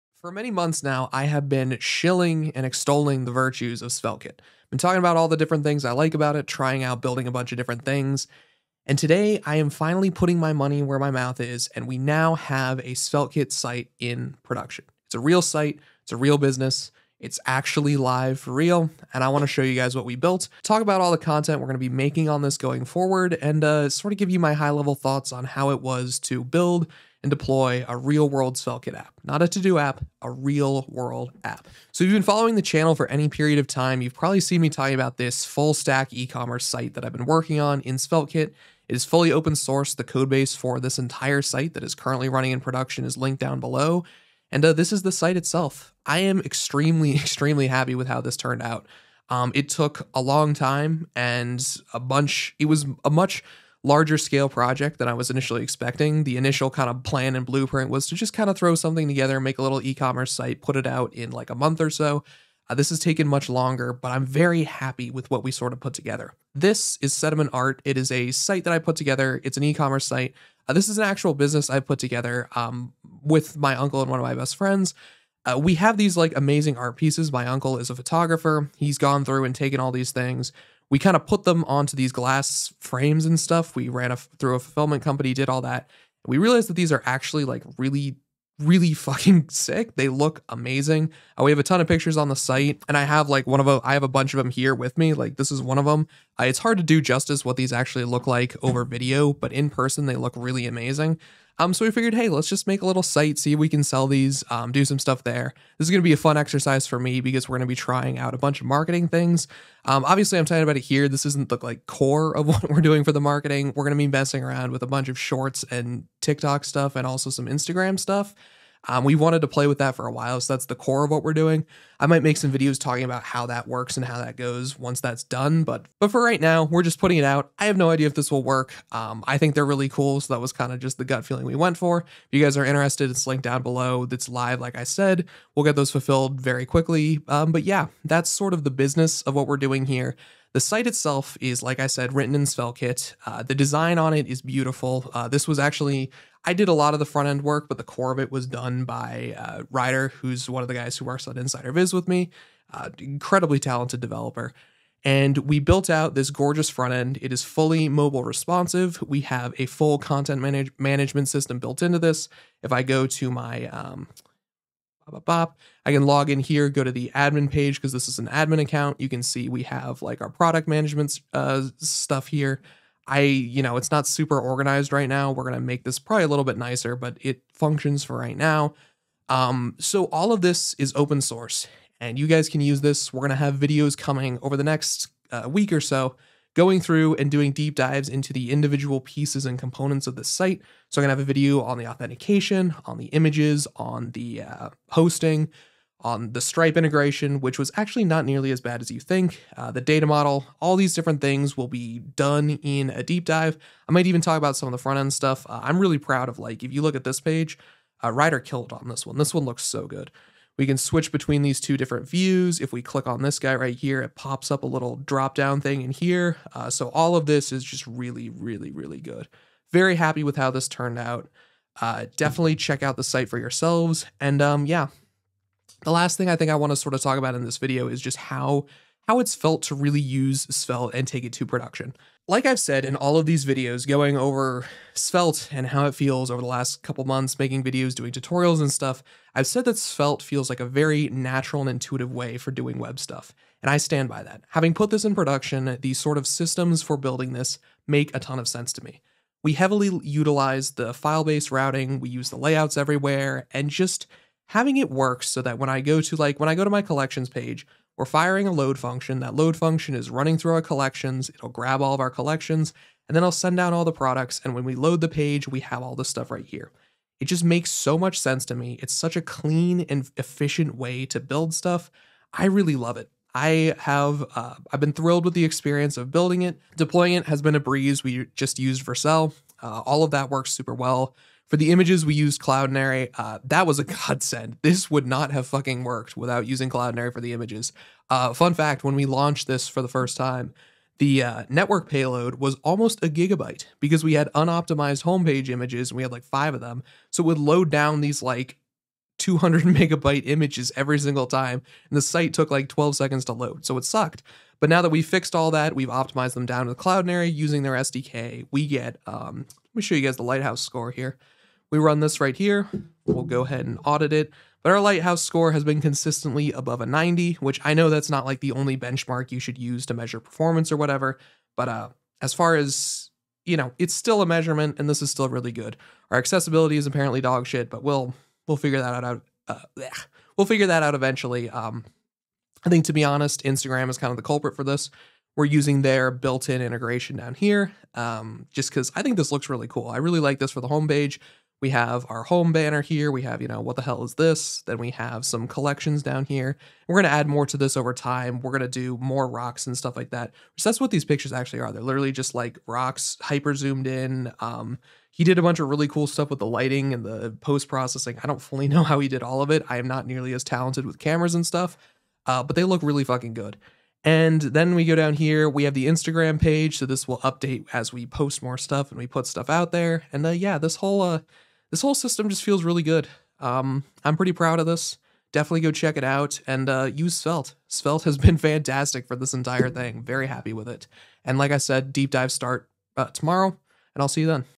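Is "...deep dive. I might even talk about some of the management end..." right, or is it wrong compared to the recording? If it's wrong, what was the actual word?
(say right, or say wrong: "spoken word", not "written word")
wrong: "front", not "management".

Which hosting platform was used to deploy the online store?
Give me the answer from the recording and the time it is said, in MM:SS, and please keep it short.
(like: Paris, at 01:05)
Vercel, at 04:38.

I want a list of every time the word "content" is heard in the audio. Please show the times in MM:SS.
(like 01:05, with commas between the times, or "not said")
00:21, 02:39.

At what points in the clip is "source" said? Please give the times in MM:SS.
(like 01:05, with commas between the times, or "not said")
00:39, 03:01.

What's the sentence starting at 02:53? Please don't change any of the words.
I, you know, it's not super organized right now.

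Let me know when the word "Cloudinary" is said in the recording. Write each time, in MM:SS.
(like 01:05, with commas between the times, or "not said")
04:42, 04:46, 05:06.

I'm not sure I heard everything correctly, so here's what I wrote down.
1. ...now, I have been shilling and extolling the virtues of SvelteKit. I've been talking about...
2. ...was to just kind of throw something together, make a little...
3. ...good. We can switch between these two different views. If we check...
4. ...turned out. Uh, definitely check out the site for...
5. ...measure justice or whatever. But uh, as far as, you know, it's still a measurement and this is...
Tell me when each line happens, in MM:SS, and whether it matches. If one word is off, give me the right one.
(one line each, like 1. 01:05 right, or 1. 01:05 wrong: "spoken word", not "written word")
1. 00:00 right
2. 00:57 right
3. 03:29 wrong: "click", not "check"
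4. 03:40 right
5. 05:19 wrong: "performance", not "justice".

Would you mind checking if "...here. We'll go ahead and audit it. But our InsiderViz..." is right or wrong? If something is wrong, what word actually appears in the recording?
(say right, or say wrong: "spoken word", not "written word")
wrong: "Lighthouse", not "InsiderViz".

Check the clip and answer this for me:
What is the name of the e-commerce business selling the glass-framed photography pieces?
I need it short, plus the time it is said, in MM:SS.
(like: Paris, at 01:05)
Sediment Art, at 01:07.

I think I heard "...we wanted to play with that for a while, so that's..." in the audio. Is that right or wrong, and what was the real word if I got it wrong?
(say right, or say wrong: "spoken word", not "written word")
right.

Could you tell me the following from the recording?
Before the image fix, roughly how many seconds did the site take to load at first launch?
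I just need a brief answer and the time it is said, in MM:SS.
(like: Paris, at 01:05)
12 seconds, at 05:02.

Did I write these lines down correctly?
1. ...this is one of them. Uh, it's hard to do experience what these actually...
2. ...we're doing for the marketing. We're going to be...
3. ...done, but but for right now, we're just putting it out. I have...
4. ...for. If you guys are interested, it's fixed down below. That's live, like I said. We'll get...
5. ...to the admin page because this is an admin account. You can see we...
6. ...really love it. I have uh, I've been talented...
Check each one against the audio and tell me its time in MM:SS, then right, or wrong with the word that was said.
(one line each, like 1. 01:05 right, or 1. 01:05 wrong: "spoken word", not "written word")
1. 01:35 wrong: "justice", not "experience"
2. 01:52 right
3. 02:05 right
4. 02:11 wrong: "linked", not "fixed"
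5. 02:46 right
6. 04:32 wrong: "thrilled", not "talented".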